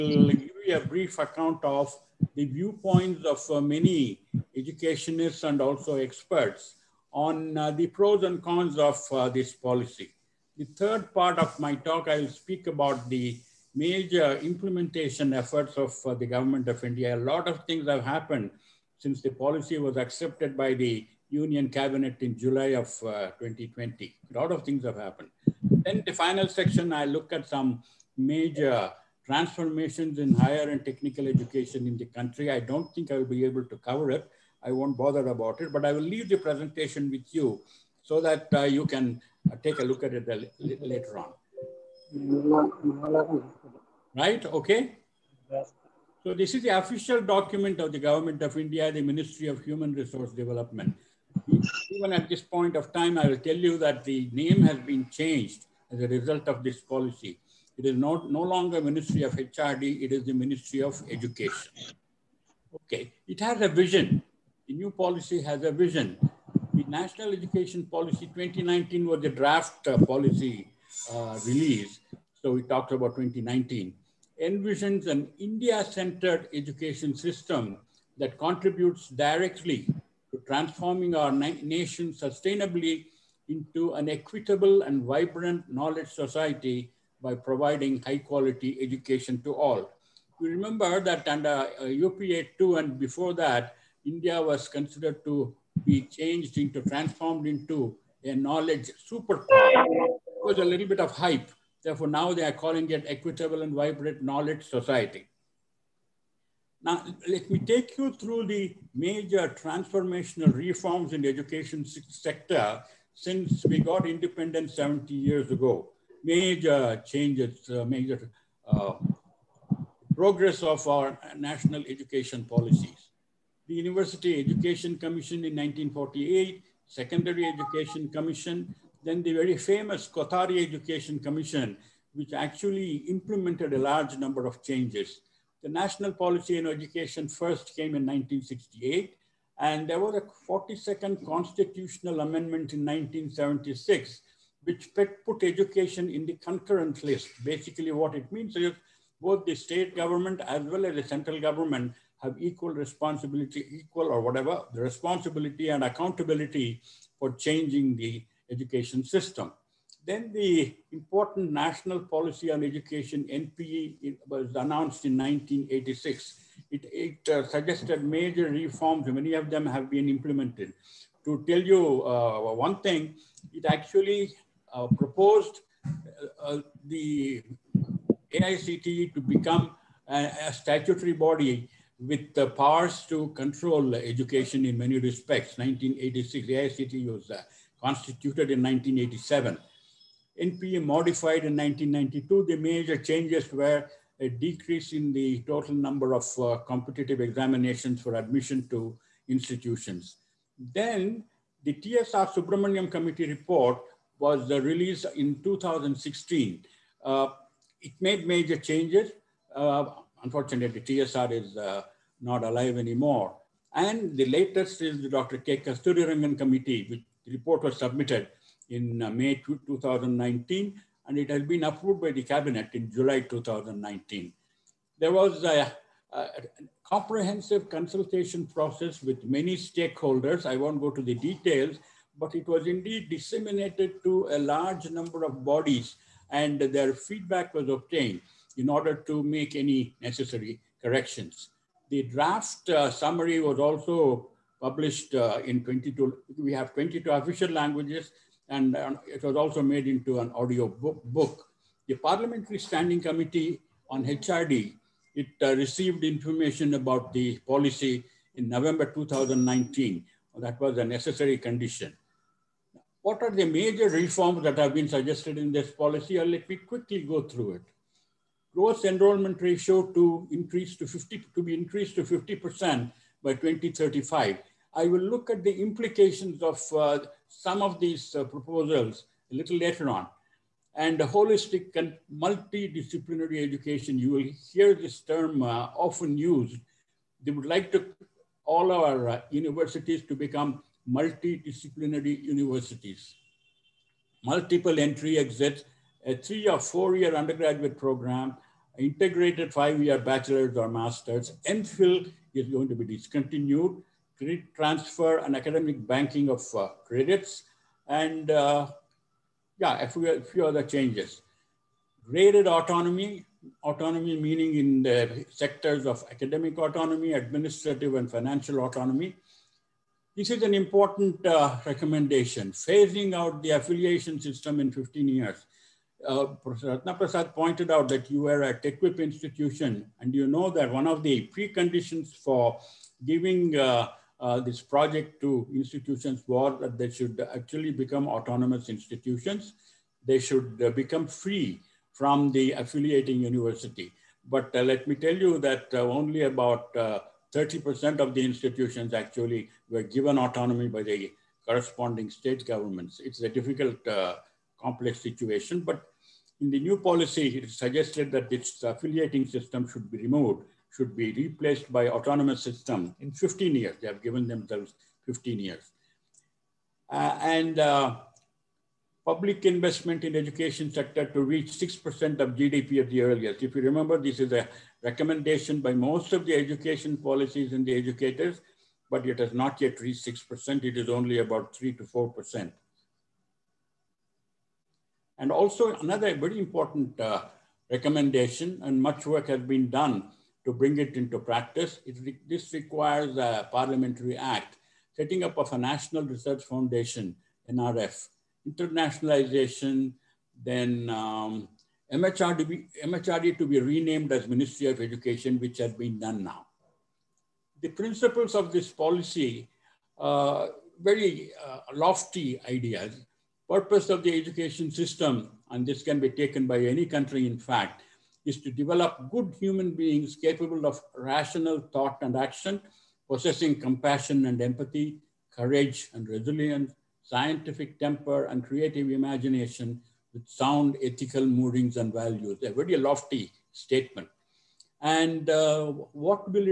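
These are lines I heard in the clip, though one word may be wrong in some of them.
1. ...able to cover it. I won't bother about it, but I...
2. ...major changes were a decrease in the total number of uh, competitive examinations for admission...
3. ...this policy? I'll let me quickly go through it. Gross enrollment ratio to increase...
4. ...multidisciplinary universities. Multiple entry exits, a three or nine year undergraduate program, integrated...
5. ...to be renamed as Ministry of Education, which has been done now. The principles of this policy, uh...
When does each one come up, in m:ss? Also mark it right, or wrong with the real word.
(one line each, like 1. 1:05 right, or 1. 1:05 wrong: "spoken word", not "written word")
1. 0:33 right
2. 3:12 right
3. 4:25 right
4. 4:50 wrong: "four", not "nine"
5. 6:43 right.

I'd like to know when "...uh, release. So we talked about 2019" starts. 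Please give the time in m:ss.
1:11.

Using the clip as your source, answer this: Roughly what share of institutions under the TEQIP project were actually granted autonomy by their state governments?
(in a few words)
30%.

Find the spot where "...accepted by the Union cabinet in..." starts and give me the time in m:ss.
0:19.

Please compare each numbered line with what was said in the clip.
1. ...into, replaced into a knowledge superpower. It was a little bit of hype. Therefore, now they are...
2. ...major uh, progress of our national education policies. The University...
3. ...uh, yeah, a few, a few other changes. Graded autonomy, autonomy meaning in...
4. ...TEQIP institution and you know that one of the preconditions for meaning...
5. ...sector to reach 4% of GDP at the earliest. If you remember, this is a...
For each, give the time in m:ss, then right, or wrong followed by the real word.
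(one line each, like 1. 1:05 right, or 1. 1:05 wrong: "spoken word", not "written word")
1. 1:36 wrong: "transformed", not "replaced"
2. 1:57 right
3. 5:08 right
4. 5:28 wrong: "giving", not "meaning"
5. 6:10 wrong: "6", not "4".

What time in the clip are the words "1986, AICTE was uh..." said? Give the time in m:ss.
3:05.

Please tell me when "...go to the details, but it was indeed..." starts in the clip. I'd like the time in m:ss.
3:50.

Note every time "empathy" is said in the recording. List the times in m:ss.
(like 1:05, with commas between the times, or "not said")
7:04.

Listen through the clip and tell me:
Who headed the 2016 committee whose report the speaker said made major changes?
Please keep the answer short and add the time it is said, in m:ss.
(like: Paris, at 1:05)
TSR Subramaniam, at 3:21.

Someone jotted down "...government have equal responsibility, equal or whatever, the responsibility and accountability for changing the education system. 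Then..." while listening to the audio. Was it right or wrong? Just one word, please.
right.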